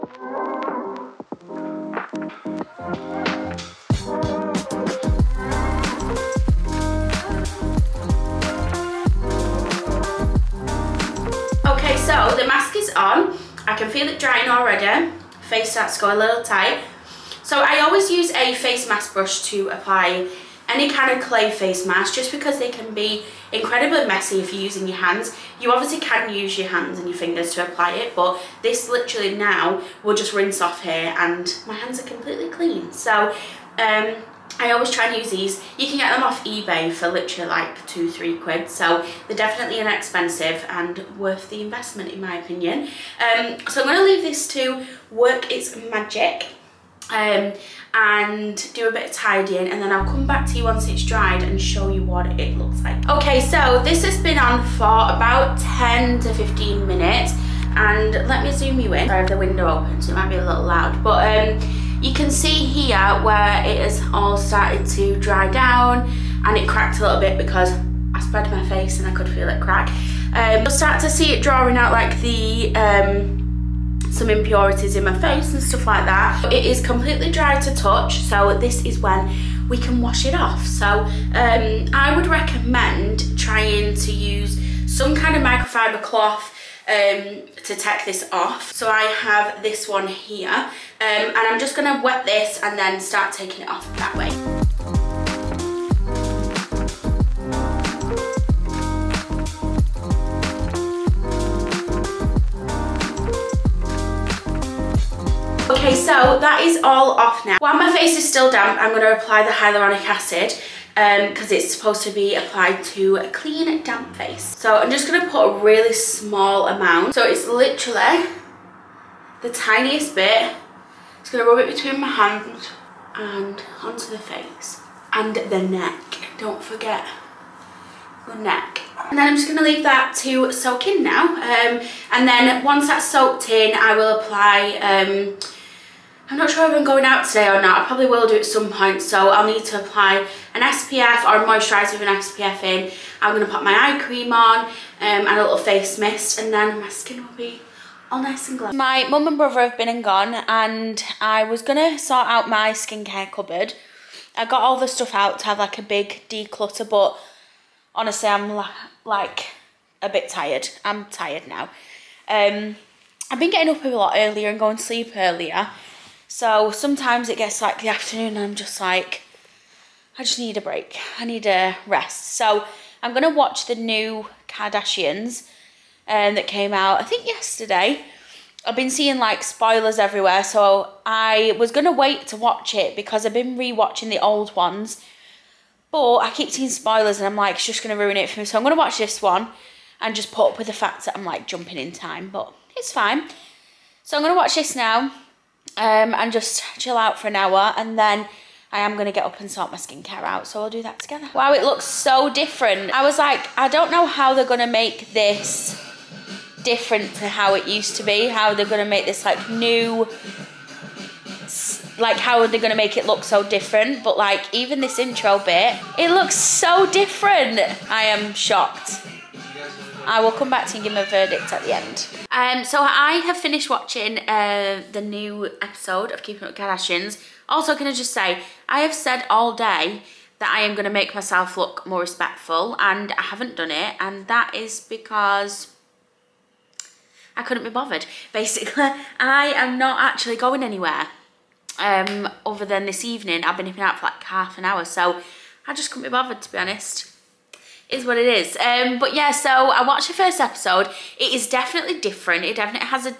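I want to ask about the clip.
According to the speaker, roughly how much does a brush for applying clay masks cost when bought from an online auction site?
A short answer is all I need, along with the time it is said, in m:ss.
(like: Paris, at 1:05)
2 or 3 pounds, at 0:37.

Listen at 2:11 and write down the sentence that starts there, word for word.
Um, and then once that's soaked in, I will apply...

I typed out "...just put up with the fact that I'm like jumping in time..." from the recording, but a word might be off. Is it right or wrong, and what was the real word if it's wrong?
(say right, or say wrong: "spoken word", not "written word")
right.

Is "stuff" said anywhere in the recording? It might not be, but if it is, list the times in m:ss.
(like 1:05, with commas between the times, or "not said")
1:15, 2:34.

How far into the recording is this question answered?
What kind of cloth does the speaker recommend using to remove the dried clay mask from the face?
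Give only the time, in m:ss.
1:25.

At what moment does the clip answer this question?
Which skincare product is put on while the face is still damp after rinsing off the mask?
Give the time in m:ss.
1:49.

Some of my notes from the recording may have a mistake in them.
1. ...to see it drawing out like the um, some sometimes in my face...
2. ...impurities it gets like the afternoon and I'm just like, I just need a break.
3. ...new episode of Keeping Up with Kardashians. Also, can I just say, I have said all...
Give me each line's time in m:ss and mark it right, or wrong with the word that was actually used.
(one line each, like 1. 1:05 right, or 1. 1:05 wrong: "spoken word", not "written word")
1. 1:10 wrong: "impurities", not "sometimes"
2. 2:46 wrong: "sometimes", not "impurities"
3. 3:44 right.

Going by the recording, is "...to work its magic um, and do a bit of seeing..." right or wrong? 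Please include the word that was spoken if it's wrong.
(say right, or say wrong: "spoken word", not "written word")
wrong: "tidying", not "seeing".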